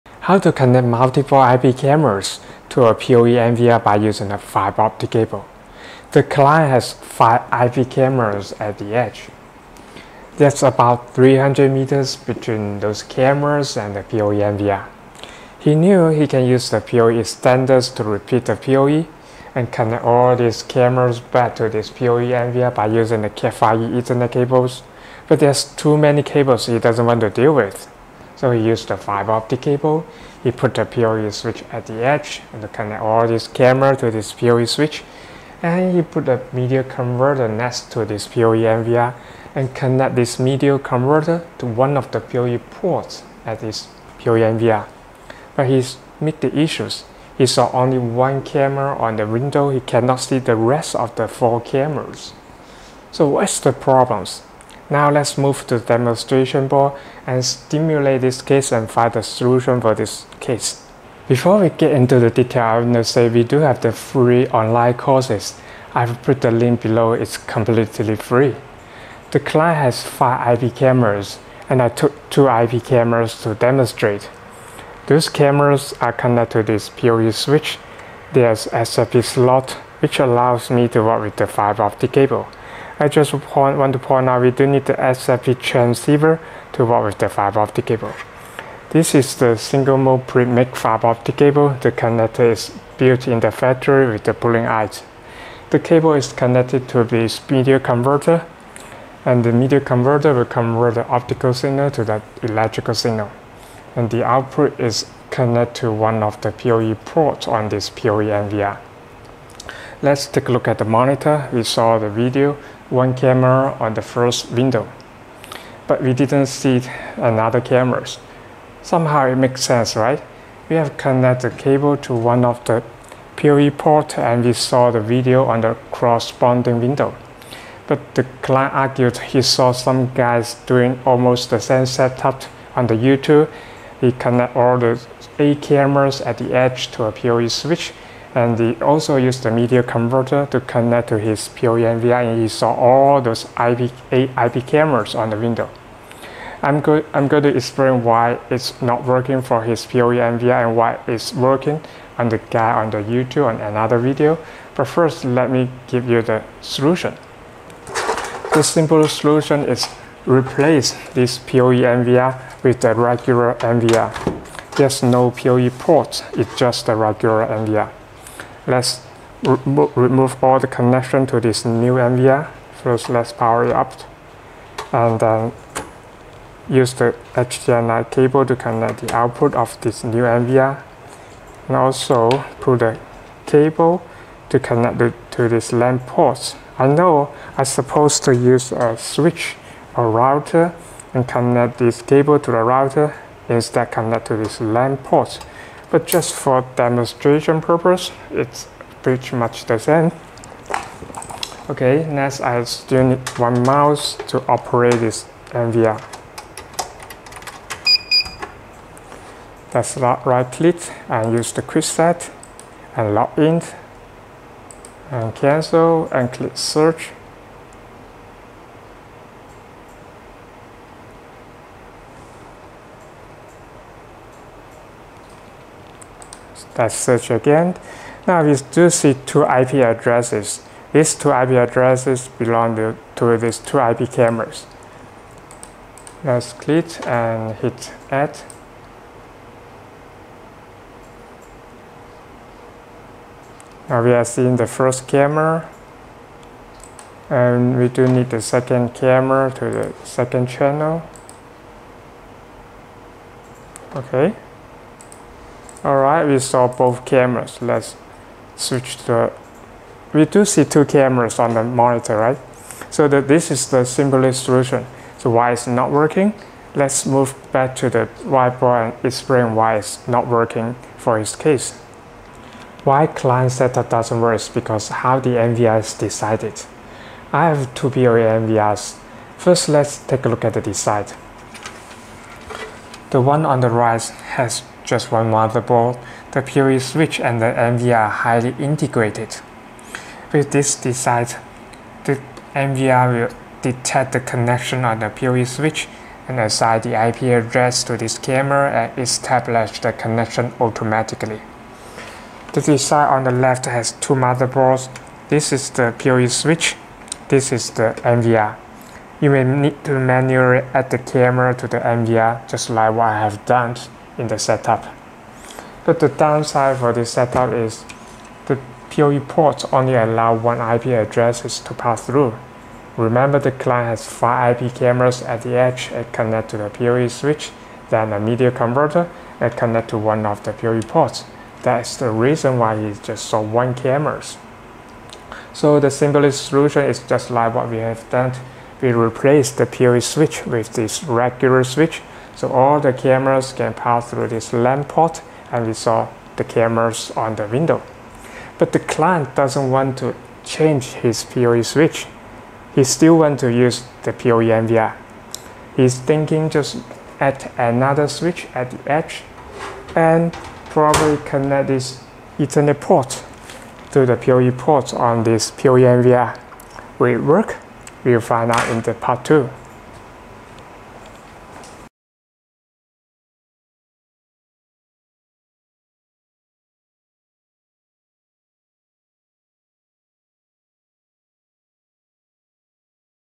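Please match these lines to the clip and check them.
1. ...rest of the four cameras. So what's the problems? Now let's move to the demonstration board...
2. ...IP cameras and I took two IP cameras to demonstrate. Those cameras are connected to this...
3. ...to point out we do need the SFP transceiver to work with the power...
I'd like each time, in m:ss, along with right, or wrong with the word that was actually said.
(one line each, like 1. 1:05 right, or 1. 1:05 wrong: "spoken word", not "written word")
1. 0:50 right
2. 1:10 right
3. 1:23 wrong: "fiber", not "power".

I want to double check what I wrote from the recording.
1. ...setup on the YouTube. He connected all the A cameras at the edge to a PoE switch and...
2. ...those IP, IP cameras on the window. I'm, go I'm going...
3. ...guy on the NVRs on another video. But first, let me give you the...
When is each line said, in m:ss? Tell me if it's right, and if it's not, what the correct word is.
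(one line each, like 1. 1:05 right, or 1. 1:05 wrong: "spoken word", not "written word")
1. 2:11 right
2. 2:23 right
3. 2:32 wrong: "YouTube", not "NVRs".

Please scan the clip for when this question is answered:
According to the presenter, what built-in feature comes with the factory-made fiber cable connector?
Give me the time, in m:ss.
1:34.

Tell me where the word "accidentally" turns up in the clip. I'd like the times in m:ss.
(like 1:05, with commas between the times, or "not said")
not said.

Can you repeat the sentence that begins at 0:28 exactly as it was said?
So he used the fiber optic cable.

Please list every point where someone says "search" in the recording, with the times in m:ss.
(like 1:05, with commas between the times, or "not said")
3:36, 3:46.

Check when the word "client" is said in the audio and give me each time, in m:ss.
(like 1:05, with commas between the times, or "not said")
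0:06, 1:09, 2:08, 4:33, 5:23, 5:48.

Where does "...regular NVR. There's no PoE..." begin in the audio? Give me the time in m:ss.
2:42.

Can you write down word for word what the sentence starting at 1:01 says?
Before we get into the detail, I want to say we do have the free online courses.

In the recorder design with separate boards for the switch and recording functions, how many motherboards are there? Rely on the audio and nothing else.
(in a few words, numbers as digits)
2.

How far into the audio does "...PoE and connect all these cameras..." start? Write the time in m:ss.
0:18.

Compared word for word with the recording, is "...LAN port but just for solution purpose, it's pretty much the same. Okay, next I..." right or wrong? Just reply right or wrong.
wrong.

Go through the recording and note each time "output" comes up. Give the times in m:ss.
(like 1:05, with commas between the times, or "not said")
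1:44, 2:59.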